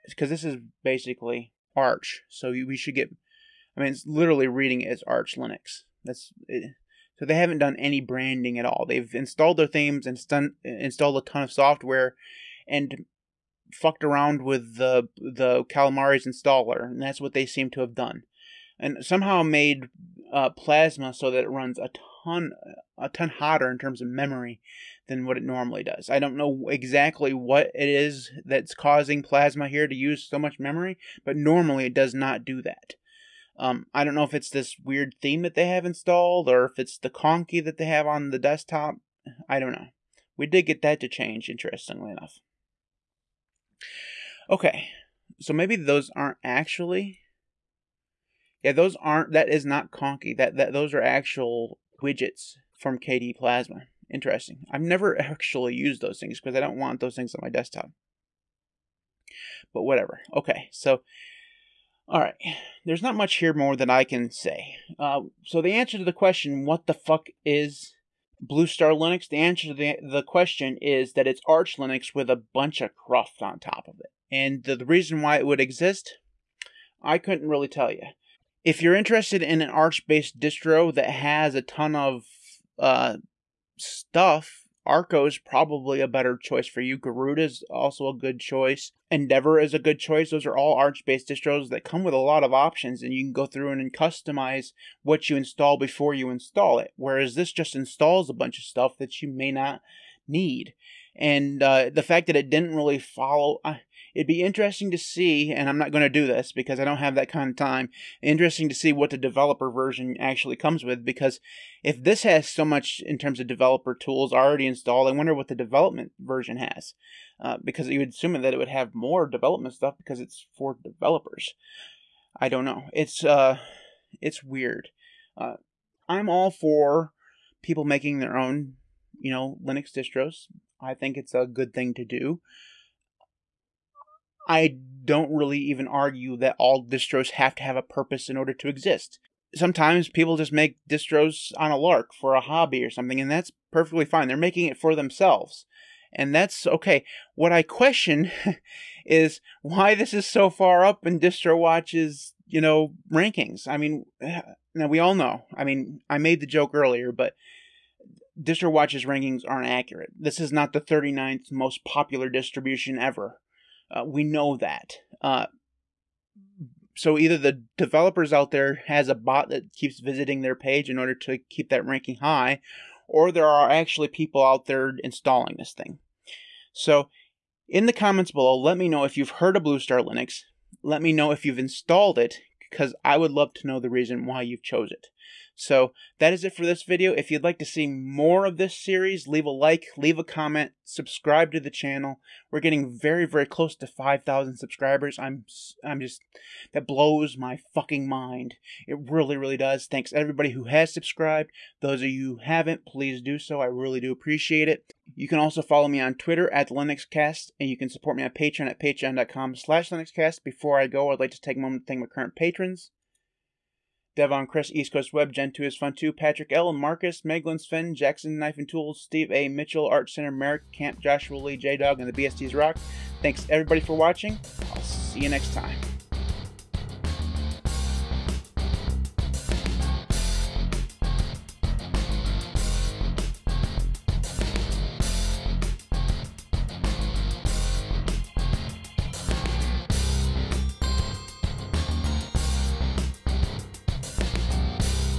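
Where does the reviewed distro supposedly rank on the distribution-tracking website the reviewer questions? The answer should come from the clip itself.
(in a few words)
39th.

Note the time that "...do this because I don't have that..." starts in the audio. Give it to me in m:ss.
1:46.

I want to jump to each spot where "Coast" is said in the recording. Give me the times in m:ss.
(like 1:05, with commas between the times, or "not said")
3:34.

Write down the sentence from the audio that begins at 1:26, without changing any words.
Garuda is also a good choice.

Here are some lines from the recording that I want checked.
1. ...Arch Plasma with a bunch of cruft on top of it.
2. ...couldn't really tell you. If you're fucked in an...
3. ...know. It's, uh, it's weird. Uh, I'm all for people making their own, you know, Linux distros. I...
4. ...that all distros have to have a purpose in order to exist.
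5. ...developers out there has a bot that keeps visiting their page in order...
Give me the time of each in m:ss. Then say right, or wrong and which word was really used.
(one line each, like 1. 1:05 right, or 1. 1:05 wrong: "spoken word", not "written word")
1. 1:11 wrong: "Linux", not "Plasma"
2. 1:17 wrong: "interested", not "fucked"
3. 2:02 right
4. 2:16 right
5. 2:47 right.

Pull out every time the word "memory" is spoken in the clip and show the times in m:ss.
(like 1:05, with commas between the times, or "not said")
0:24, 0:30.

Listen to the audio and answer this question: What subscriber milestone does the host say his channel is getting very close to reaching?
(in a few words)
5,000.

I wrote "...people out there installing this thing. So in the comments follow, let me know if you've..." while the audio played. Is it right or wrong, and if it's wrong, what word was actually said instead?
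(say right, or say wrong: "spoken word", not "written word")
wrong: "below", not "follow".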